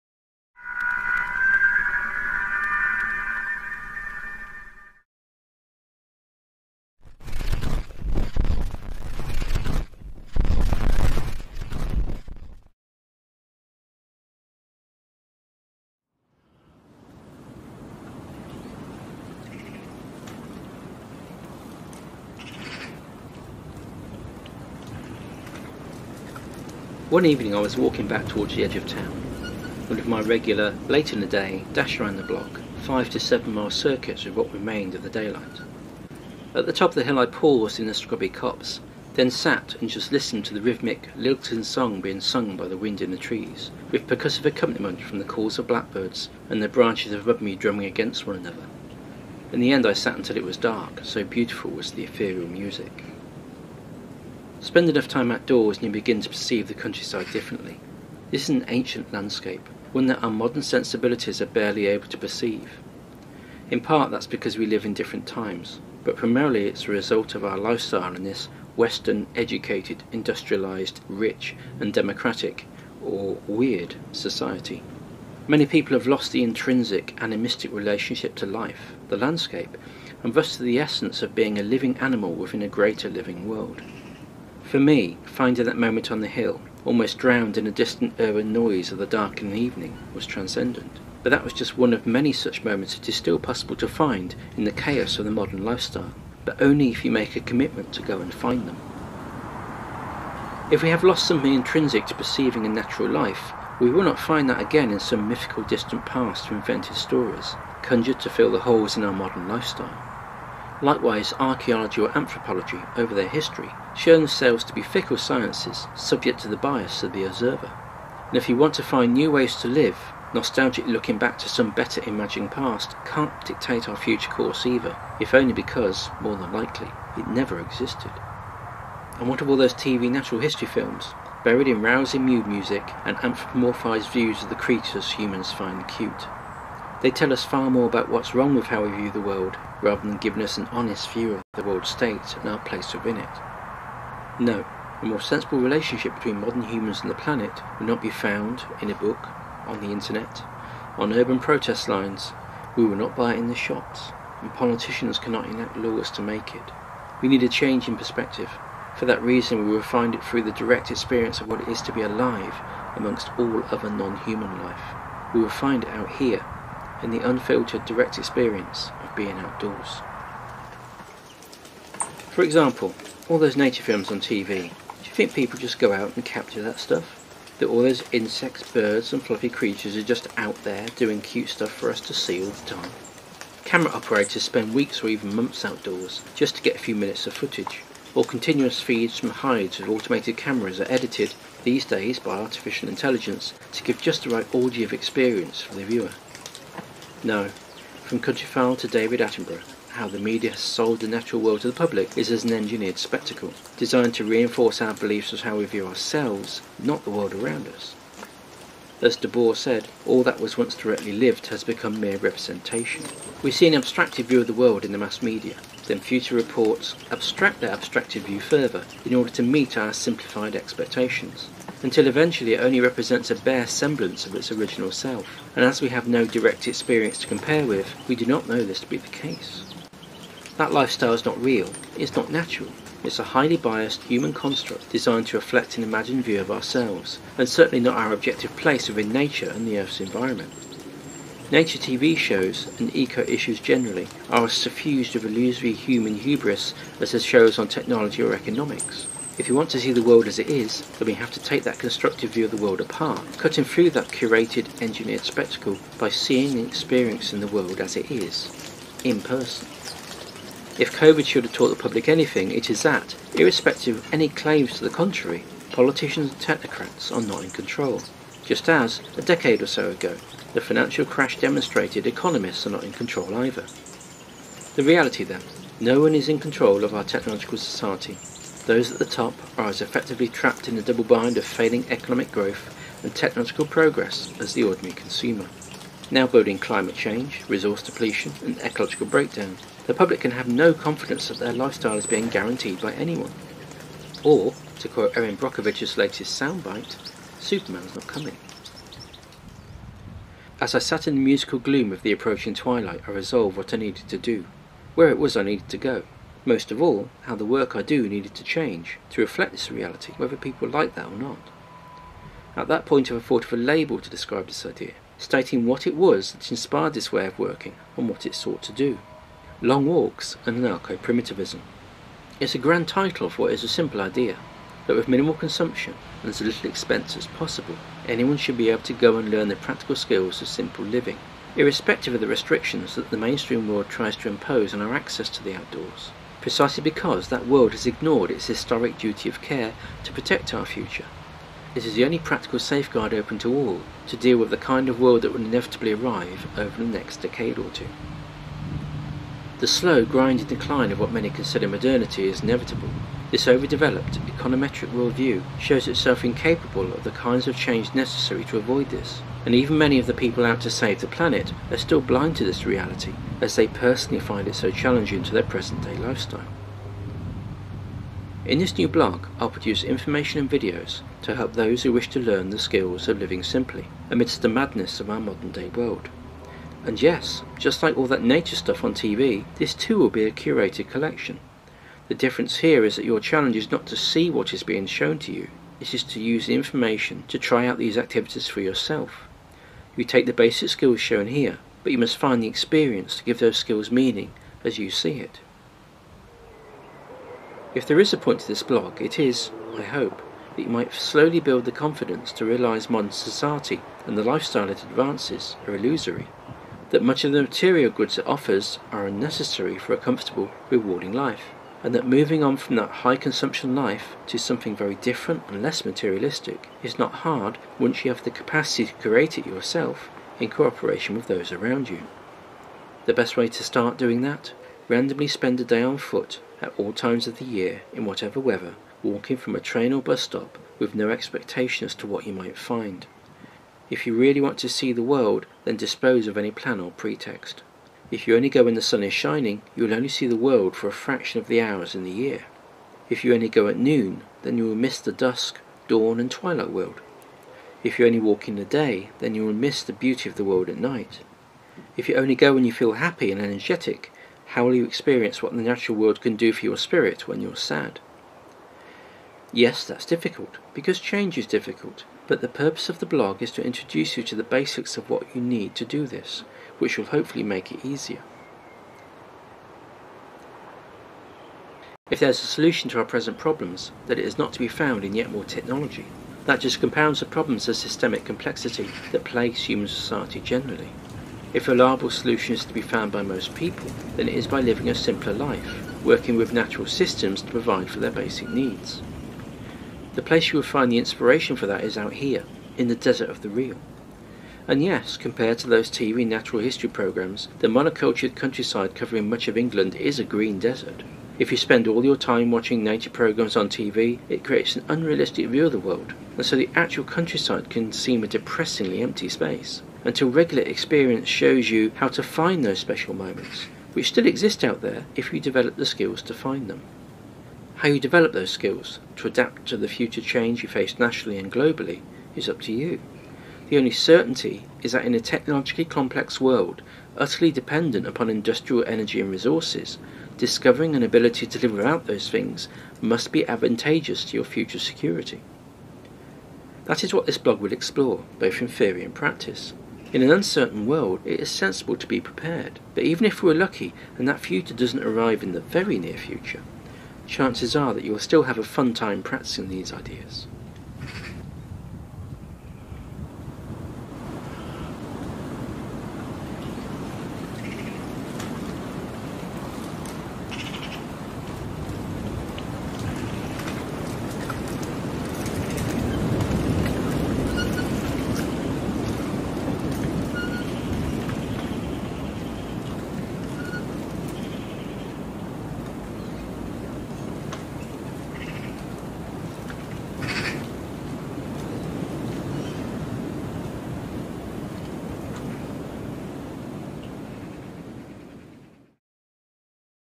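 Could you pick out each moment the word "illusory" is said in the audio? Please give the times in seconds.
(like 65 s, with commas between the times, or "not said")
245 s, 405 s.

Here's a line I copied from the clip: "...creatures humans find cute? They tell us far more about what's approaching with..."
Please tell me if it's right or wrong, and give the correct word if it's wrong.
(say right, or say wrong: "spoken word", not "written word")
wrong: "wrong", not "approaching".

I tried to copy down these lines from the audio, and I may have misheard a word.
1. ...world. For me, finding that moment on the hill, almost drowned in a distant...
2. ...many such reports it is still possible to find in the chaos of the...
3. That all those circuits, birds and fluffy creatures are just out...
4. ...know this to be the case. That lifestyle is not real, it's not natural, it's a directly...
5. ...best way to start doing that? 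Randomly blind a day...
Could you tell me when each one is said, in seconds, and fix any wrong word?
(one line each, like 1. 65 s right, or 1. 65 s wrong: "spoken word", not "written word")
1. 83 s right
2. 92 s wrong: "moments", not "reports"
3. 177 s wrong: "insects", not "circuits"
4. 228 s wrong: "highly", not "directly"
5. 423 s wrong: "spend", not "blind".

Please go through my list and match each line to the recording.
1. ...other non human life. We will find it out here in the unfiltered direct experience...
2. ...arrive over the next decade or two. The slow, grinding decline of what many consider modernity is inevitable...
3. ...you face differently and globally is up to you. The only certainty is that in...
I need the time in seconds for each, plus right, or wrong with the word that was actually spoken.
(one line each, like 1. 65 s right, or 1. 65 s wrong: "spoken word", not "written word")
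1. 163 s right
2. 345 s right
3. 520 s wrong: "nationally", not "differently".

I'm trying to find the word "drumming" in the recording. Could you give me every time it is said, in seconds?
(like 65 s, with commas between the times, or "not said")
47 s.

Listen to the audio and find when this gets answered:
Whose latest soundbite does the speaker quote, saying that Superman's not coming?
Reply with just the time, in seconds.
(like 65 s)
295 s.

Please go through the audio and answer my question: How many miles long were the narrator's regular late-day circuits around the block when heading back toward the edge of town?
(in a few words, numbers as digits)
5 to 7 miles.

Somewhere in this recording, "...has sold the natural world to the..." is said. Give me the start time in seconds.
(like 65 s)
200 s.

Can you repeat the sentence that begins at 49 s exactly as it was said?
In the end I sat until it was dark, so beautiful was the ethereal music.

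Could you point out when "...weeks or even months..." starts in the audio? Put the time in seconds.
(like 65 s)
184 s.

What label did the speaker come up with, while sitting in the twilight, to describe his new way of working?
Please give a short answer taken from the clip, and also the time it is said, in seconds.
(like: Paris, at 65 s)
Long Walks and Anarcho Primitivism, at 319 s.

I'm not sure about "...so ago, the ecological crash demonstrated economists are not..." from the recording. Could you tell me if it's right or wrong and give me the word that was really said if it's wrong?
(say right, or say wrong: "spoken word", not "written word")
wrong: "financial", not "ecological".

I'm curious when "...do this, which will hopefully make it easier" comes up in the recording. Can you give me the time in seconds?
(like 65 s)
465 s.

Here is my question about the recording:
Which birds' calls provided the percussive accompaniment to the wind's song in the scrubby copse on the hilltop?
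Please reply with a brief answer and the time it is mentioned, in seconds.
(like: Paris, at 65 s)
blackbirds, at 45 s.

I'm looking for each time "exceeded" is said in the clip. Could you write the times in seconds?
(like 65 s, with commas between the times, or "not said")
not said.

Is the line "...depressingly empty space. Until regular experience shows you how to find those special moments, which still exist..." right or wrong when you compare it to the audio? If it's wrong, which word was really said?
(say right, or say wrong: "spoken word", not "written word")
right.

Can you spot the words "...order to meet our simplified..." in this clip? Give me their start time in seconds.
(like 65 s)
219 s.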